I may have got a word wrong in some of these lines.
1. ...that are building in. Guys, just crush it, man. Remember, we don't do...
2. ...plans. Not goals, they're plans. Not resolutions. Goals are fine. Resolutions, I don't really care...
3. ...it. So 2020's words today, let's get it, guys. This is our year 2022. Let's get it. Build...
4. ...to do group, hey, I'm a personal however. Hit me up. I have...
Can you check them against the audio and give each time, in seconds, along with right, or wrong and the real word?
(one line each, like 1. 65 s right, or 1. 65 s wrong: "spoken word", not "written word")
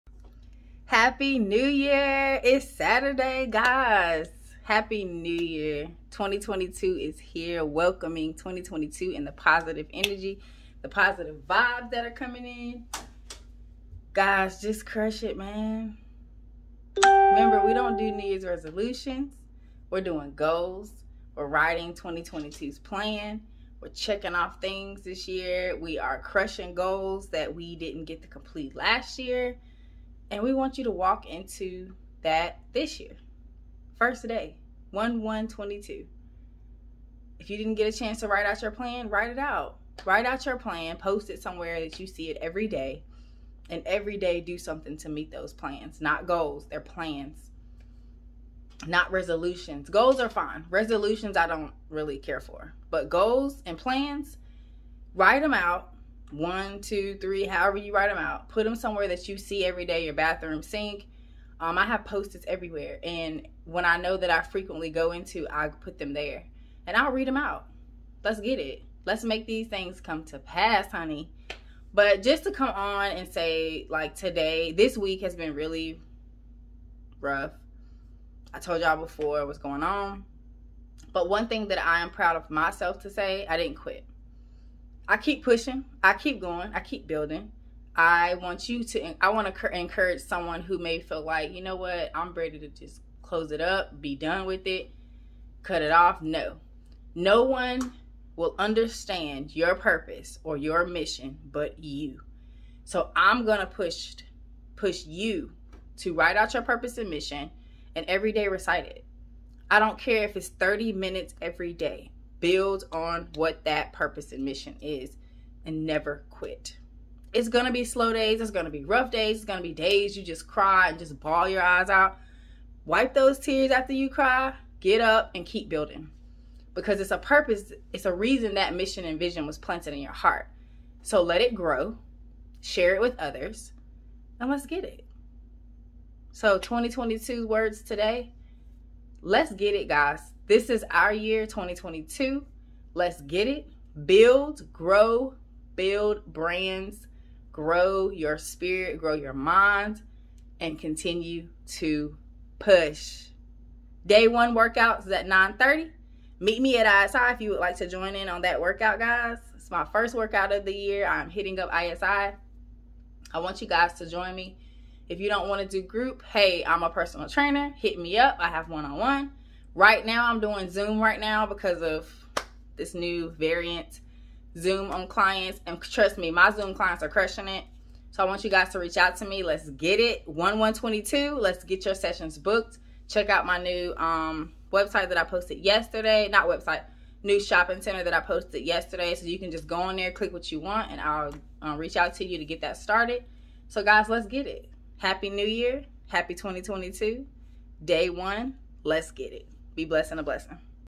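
1. 11 s wrong: "coming", not "building"
2. 45 s right
3. 134 s wrong: "2022", not "2020"
4. 165 s wrong: "trainer", not "however".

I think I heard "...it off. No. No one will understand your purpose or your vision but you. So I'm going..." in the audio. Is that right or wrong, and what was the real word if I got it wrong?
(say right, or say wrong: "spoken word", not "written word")
wrong: "mission", not "vision".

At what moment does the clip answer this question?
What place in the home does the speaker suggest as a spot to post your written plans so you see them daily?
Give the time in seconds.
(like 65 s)
60 s.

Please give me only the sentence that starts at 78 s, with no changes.
I told y'all before what's going on.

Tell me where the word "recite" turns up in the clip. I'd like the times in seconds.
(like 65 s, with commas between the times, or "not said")
108 s.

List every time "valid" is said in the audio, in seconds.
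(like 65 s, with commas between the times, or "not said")
not said.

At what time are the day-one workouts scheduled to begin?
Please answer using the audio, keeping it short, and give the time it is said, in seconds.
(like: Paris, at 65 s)
9:30, at 155 s.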